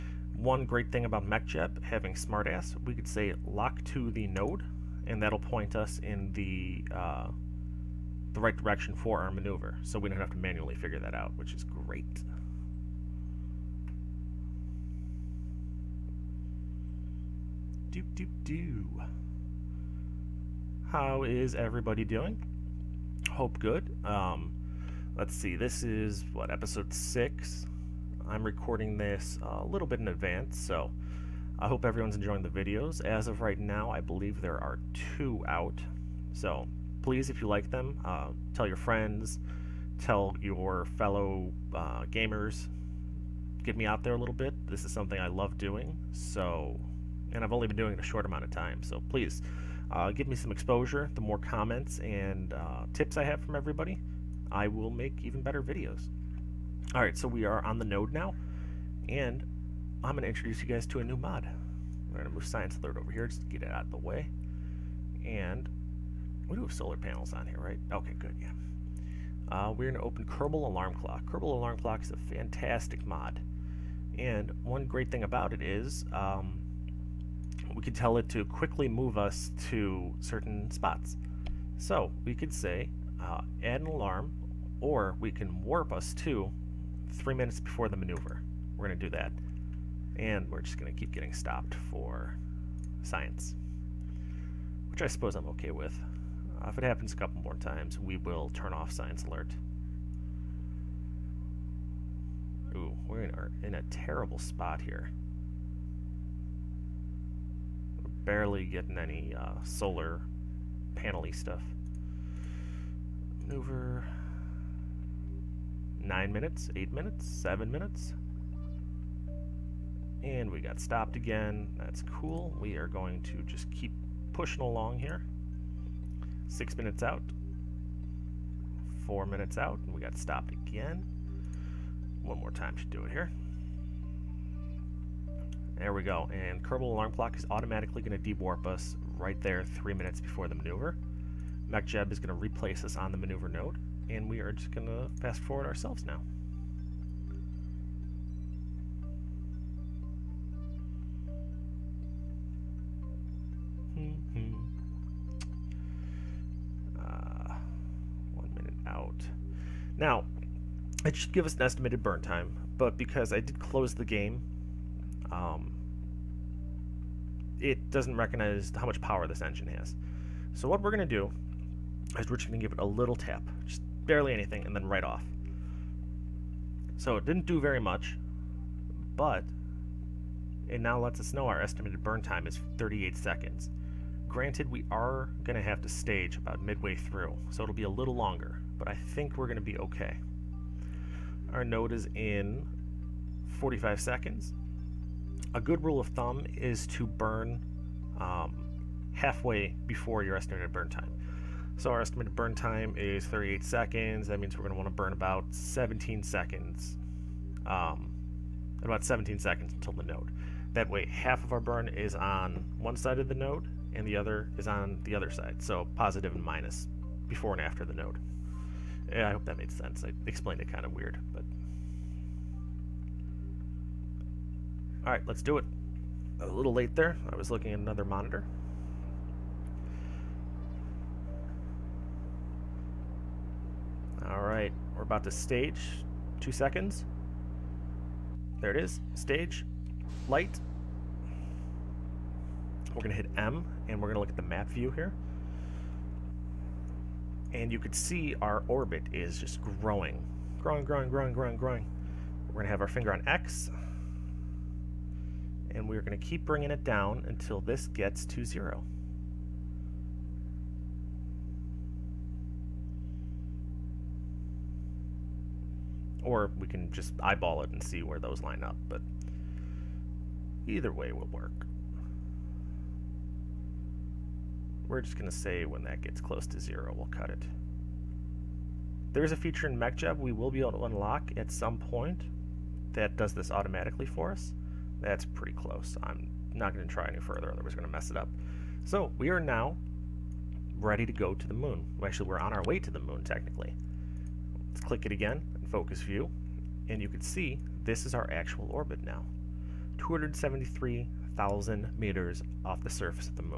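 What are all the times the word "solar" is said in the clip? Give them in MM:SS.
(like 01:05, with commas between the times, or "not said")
01:06, 01:49.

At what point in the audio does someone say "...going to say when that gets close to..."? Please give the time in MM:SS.
04:35.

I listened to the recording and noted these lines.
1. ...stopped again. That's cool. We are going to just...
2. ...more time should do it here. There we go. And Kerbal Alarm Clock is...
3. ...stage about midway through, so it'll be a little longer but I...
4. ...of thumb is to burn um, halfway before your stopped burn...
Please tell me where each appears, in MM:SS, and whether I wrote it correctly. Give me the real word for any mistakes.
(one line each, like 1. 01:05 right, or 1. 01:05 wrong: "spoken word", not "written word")
1. 02:00 right
2. 02:12 right
3. 03:05 right
4. 03:16 wrong: "estimated", not "stopped".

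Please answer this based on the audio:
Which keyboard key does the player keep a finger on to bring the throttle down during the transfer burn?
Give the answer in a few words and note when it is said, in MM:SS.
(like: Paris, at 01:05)
X, at 04:13.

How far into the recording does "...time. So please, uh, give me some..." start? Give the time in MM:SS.
00:48.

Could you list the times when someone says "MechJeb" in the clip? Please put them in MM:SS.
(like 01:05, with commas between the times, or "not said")
00:01, 02:21, 04:39.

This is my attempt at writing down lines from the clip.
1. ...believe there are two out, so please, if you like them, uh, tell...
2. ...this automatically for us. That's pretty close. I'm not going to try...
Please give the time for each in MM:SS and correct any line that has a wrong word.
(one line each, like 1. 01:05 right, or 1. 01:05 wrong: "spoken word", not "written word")
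1. 00:34 right
2. 04:43 right.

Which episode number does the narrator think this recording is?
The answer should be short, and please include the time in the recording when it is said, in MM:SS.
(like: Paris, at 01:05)
6, at 00:26.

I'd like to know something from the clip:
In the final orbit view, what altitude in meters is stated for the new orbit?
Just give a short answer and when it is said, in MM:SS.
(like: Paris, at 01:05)
273,000 meters, at 04:59.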